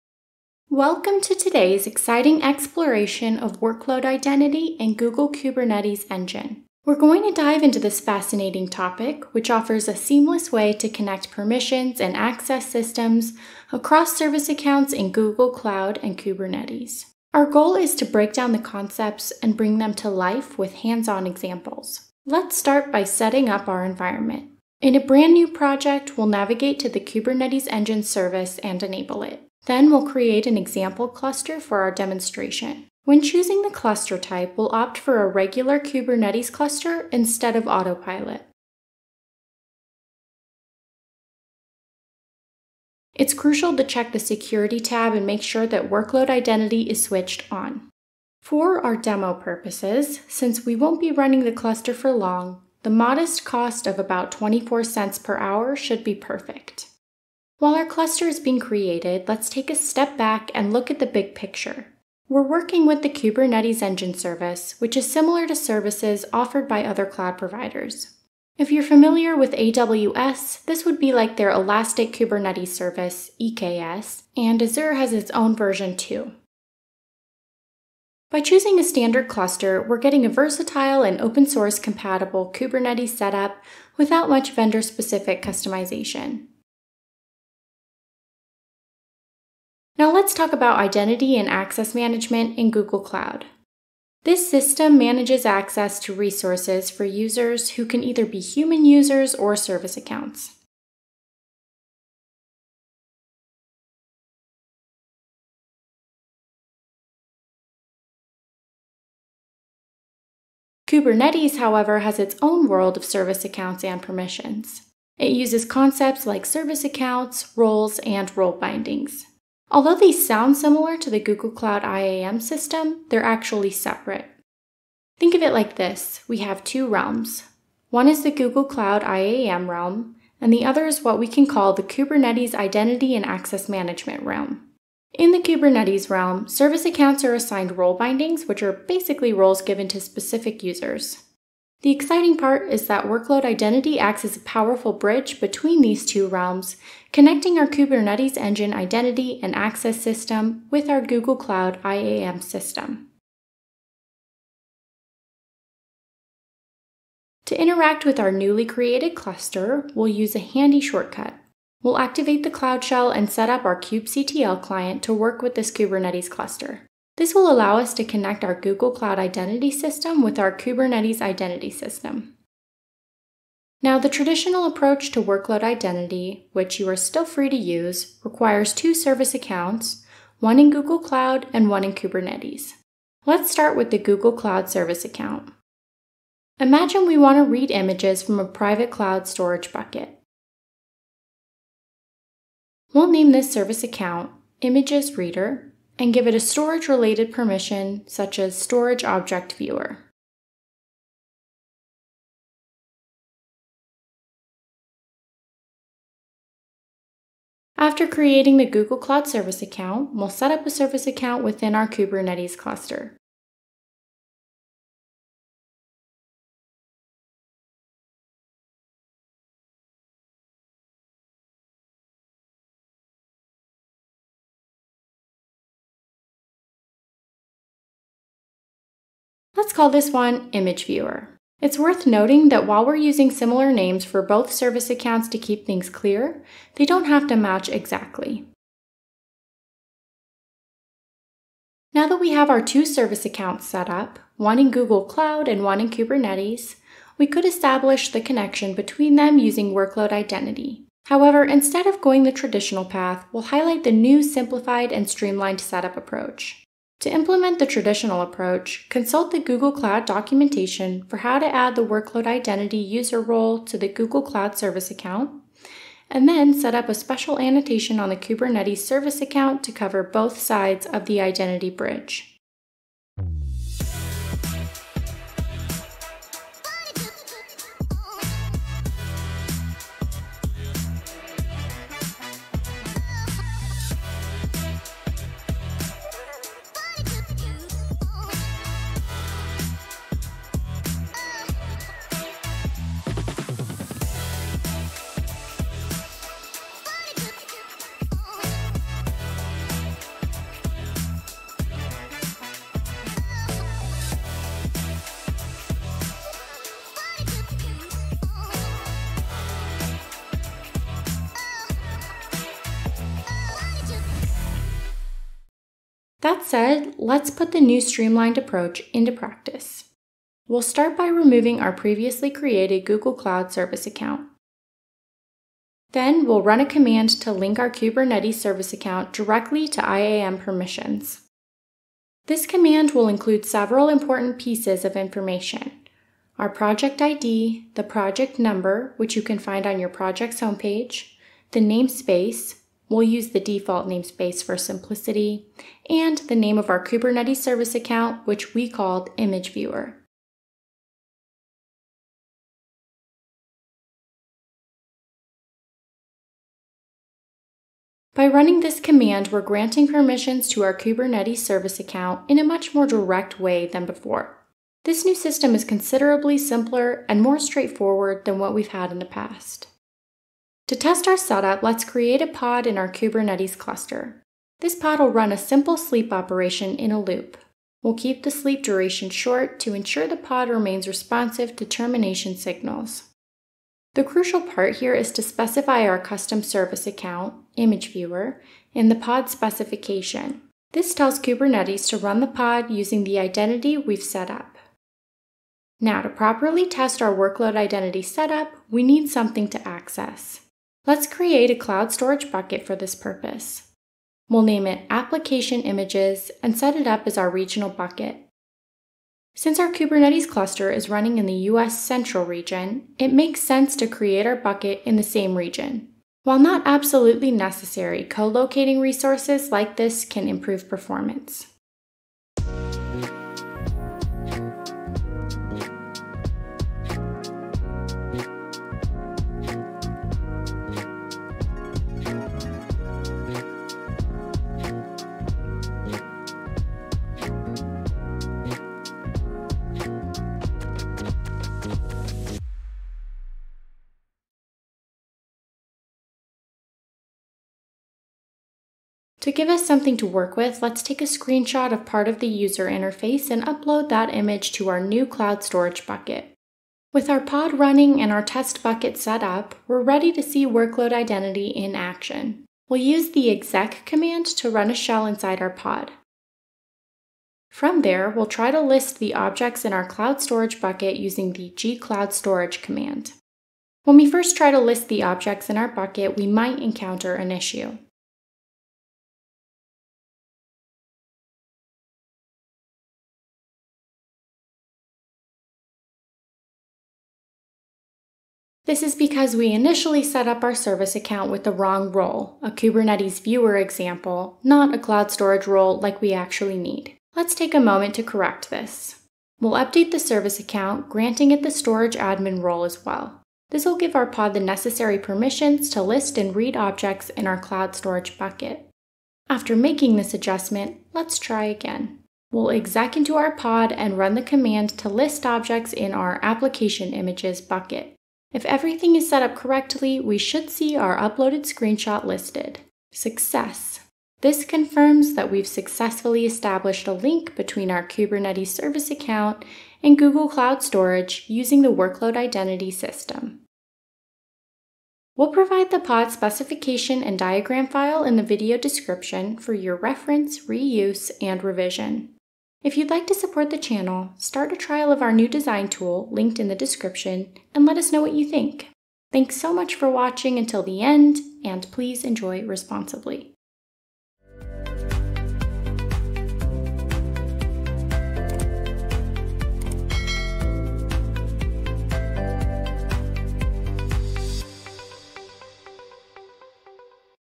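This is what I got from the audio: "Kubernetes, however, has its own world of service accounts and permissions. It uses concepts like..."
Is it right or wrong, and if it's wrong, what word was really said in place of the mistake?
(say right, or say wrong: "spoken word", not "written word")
right.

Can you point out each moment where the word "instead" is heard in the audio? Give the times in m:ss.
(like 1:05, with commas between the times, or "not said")
0:37, 4:11.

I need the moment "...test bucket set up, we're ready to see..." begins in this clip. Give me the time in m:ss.
7:38.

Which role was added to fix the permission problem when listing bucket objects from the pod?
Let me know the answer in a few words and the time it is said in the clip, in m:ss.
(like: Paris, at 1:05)
storage admin, at 8:21.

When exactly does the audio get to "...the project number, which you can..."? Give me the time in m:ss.
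5:37.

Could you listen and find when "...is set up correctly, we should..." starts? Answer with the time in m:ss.
8:38.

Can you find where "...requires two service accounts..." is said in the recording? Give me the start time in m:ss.
2:58.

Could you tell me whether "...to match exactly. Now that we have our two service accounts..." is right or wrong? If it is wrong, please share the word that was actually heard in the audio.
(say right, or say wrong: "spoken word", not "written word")
right.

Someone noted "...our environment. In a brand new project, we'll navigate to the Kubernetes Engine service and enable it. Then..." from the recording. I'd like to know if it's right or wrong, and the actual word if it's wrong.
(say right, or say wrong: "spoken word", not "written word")
right.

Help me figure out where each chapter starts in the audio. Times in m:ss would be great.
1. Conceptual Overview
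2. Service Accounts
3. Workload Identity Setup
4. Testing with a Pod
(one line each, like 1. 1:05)
1. 1:02
2. 2:36
3. 4:00
4. 6:10.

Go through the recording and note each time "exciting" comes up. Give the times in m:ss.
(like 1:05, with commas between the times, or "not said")
0:01, 2:21.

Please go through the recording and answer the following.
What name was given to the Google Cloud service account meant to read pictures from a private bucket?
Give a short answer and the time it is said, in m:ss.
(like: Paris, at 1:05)
Images Reader, at 3:14.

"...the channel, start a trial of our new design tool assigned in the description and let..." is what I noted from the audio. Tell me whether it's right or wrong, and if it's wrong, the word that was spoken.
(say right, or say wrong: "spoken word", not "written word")
wrong: "linked", not "assigned".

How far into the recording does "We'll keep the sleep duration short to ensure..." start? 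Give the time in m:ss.
6:17.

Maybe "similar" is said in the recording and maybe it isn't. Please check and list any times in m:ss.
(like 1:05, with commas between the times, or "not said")
1:05, 2:00, 3:53.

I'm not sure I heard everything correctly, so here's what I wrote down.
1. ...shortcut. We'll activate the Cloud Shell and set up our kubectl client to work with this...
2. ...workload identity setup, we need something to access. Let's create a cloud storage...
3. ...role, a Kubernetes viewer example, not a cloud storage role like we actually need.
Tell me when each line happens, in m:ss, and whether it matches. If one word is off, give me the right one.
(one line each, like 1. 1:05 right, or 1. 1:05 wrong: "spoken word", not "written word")
1. 2:40 right
2. 6:37 right
3. 8:11 right.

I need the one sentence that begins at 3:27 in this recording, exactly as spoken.
After creating the Google Cloud Service account, we'll set up a service account within our Kubernetes cluster.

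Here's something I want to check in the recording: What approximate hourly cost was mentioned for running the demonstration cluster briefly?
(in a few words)
24 cents.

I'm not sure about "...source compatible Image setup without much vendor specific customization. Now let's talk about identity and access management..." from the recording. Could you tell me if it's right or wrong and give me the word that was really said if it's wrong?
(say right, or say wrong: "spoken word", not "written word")
wrong: "Kubernetes", not "Image".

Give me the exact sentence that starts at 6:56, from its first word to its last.
While not absolutely necessary, co-locating resources like this can improve performance.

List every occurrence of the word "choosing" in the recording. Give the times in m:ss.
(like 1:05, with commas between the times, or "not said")
0:33, 1:18.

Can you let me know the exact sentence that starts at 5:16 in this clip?
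That said, let's put the new streamlined approach into practice.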